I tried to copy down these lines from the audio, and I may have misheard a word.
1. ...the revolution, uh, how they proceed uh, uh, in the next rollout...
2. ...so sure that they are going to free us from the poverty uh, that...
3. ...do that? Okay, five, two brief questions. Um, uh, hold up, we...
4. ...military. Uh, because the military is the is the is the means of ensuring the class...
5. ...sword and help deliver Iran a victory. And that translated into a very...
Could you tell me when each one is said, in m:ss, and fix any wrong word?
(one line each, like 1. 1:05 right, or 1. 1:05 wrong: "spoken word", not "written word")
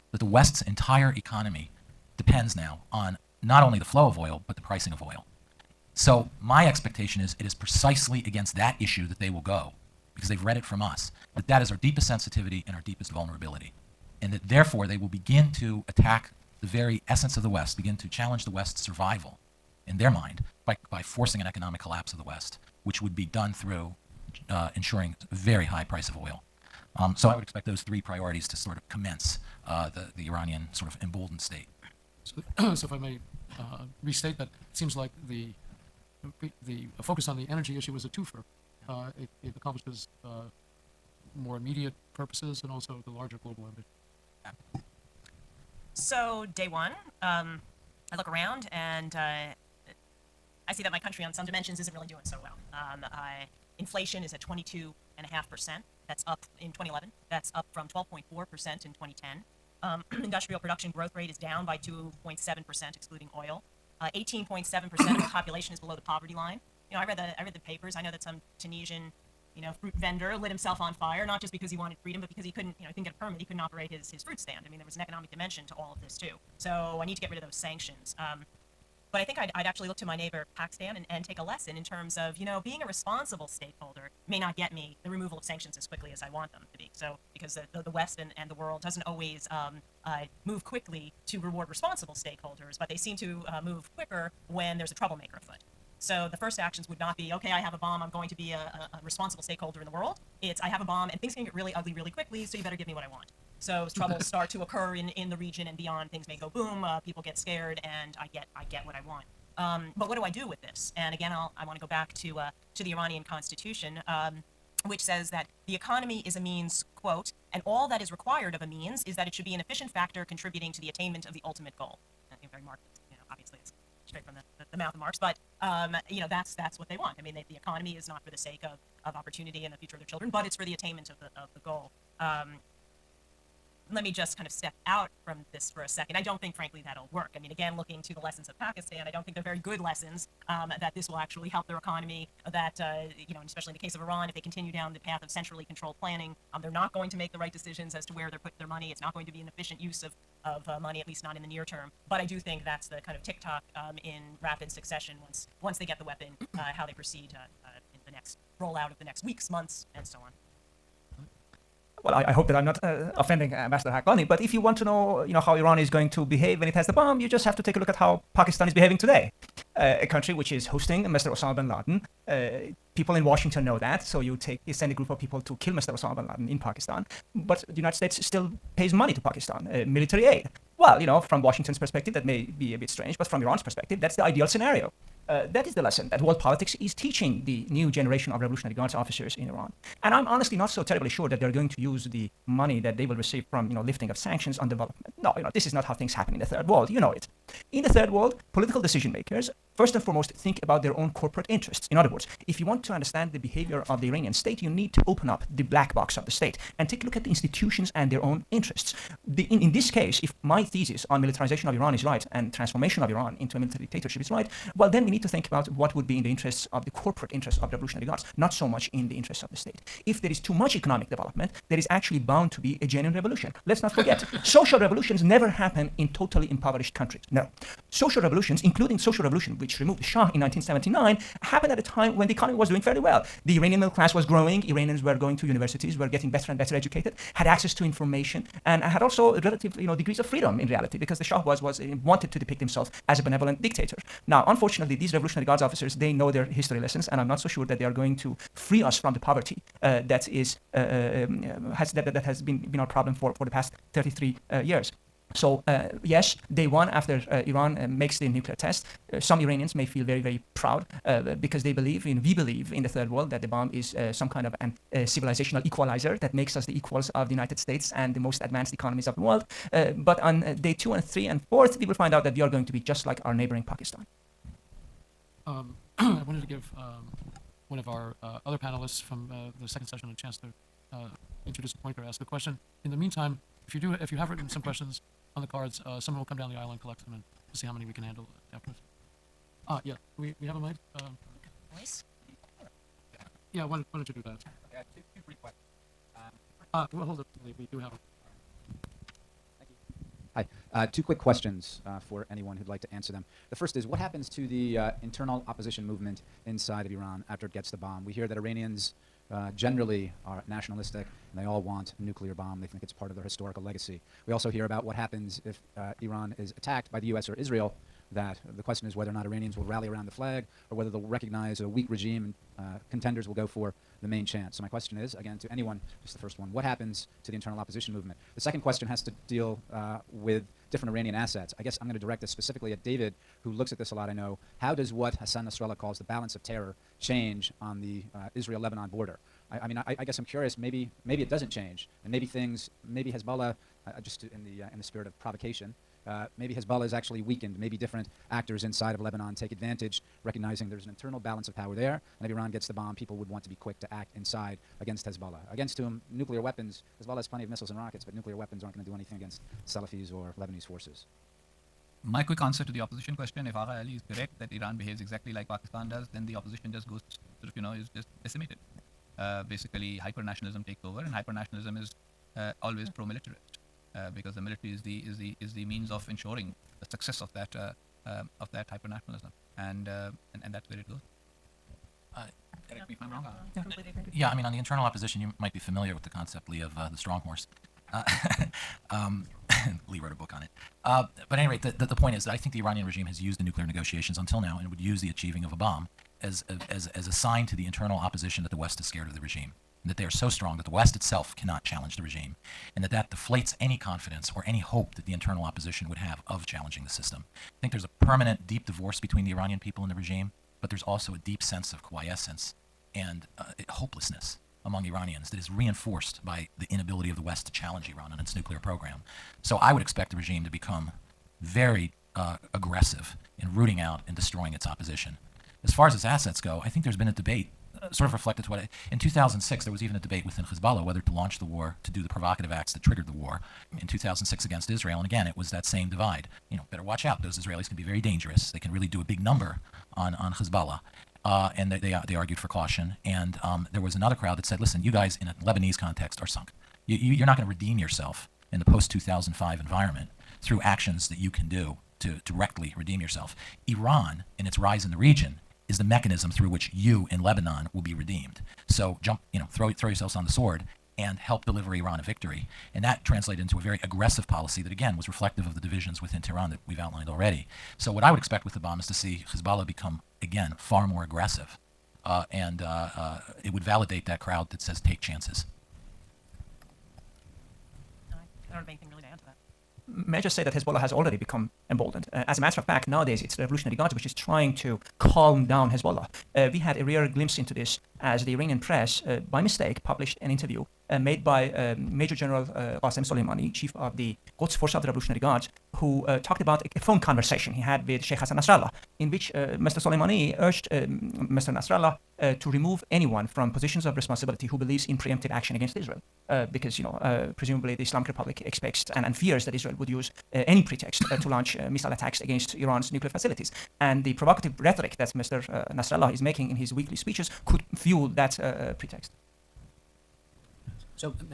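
1. 2:36 wrong: "weapon", not "revolution"
2. 4:07 right
3. 4:54 wrong: "two", not "five"
4. 6:13 wrong: "success", not "class"
5. 7:40 right.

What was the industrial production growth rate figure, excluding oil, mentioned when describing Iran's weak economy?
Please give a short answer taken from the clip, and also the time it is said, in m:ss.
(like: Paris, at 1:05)
down 2.7%, at 1:01.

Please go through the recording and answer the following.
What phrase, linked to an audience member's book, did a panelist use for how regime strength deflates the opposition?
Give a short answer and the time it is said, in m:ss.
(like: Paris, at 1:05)
the strong horse, at 6:26.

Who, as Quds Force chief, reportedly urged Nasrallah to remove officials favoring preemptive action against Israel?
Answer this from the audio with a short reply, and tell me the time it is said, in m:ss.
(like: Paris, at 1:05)
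Qasem Soleimani, at 8:12.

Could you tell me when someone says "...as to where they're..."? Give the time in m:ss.
2:27.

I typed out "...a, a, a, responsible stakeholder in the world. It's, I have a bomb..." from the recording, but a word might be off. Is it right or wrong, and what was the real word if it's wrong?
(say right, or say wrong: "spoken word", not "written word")
right.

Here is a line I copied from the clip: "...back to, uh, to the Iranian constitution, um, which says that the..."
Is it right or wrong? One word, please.
right.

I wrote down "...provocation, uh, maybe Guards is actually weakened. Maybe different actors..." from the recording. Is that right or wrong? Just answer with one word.
wrong.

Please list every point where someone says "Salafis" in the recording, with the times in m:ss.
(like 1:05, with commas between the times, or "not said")
5:59.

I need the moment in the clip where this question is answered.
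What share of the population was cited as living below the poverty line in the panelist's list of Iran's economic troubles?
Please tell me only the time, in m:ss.
1:04.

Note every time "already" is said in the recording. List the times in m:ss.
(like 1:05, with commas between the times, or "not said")
7:47, 8:00.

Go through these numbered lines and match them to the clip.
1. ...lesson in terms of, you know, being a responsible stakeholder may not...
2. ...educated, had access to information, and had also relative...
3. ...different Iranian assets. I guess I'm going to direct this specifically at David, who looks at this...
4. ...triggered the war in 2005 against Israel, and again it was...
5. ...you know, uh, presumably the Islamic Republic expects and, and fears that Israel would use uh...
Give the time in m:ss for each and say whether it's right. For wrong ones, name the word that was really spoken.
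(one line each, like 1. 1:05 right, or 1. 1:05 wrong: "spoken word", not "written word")
1. 1:21 right
2. 3:56 right
3. 5:30 right
4. 7:12 wrong: "2006", not "2005"
5. 8:26 right.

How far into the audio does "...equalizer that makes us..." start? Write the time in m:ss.
4:25.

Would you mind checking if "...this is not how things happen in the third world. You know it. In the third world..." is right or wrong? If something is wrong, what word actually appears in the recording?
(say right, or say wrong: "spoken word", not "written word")
right.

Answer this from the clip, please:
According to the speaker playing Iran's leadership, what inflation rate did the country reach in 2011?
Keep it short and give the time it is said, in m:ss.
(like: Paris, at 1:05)
22.5%, at 0:54.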